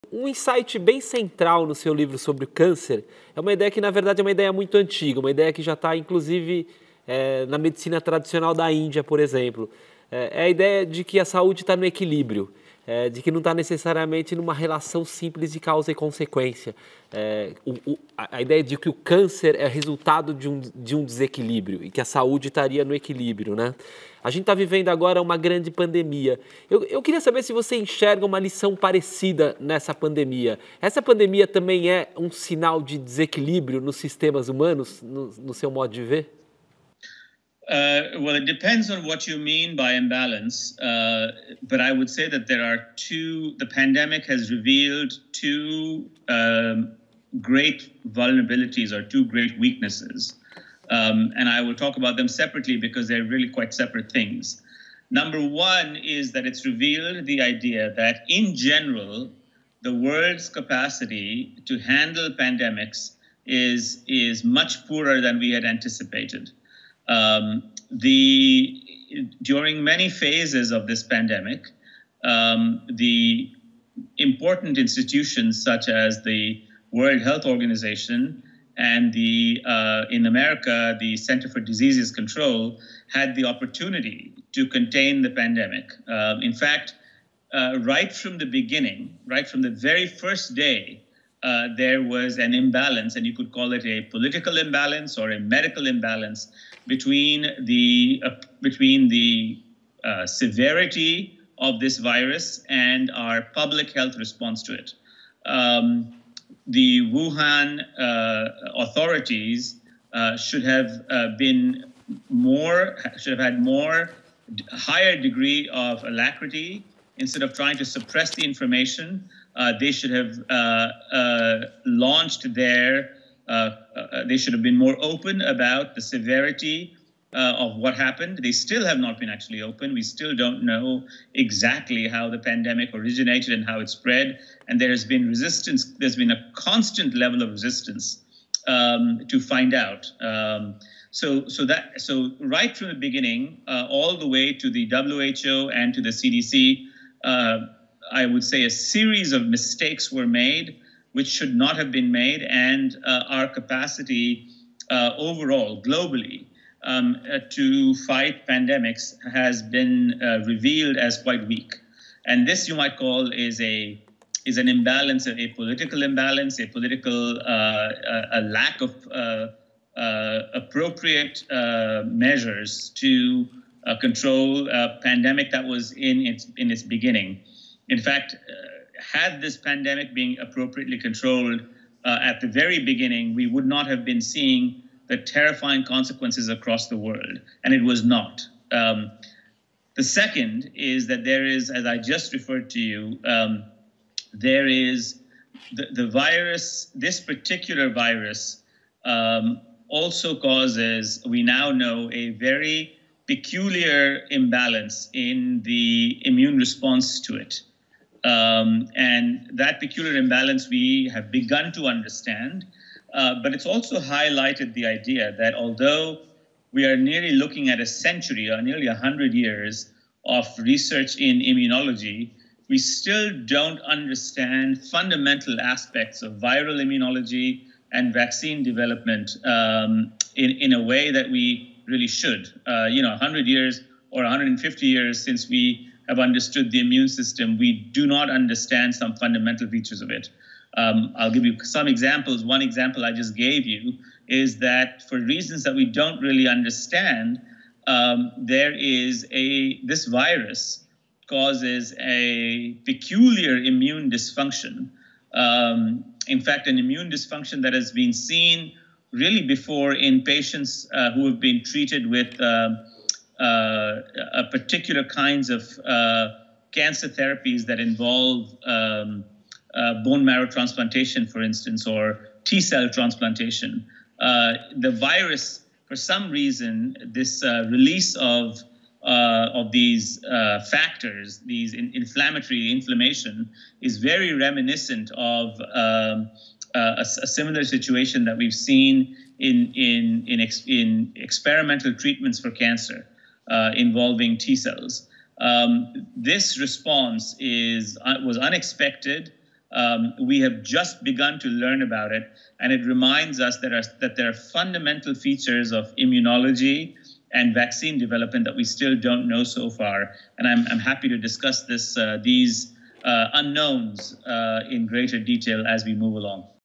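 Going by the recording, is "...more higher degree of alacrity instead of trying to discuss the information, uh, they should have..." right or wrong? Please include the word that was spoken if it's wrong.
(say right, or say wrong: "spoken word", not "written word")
wrong: "suppress", not "discuss".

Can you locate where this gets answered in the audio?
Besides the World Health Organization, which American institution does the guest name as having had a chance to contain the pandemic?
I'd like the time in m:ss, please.
1:21.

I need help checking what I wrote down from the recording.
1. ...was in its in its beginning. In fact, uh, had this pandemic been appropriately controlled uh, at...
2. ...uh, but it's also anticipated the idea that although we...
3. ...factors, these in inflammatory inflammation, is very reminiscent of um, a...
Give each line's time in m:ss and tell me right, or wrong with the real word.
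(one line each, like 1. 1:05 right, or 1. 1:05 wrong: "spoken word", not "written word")
1. 2:55 right
2. 3:33 wrong: "highlighted", not "anticipated"
3. 4:40 right.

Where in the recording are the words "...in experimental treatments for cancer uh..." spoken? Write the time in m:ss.
4:50.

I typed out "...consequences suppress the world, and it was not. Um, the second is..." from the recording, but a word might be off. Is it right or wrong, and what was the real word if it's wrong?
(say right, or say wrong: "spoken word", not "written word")
wrong: "across", not "suppress".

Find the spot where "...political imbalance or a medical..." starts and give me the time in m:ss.
1:34.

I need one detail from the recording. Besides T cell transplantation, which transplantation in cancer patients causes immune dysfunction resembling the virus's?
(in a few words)
bone marrow transplantation.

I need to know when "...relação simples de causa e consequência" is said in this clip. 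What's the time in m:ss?
0:14.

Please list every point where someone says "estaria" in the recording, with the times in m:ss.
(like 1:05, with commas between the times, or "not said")
0:22.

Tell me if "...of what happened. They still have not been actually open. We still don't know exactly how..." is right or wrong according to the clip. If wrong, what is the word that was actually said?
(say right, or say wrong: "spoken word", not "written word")
right.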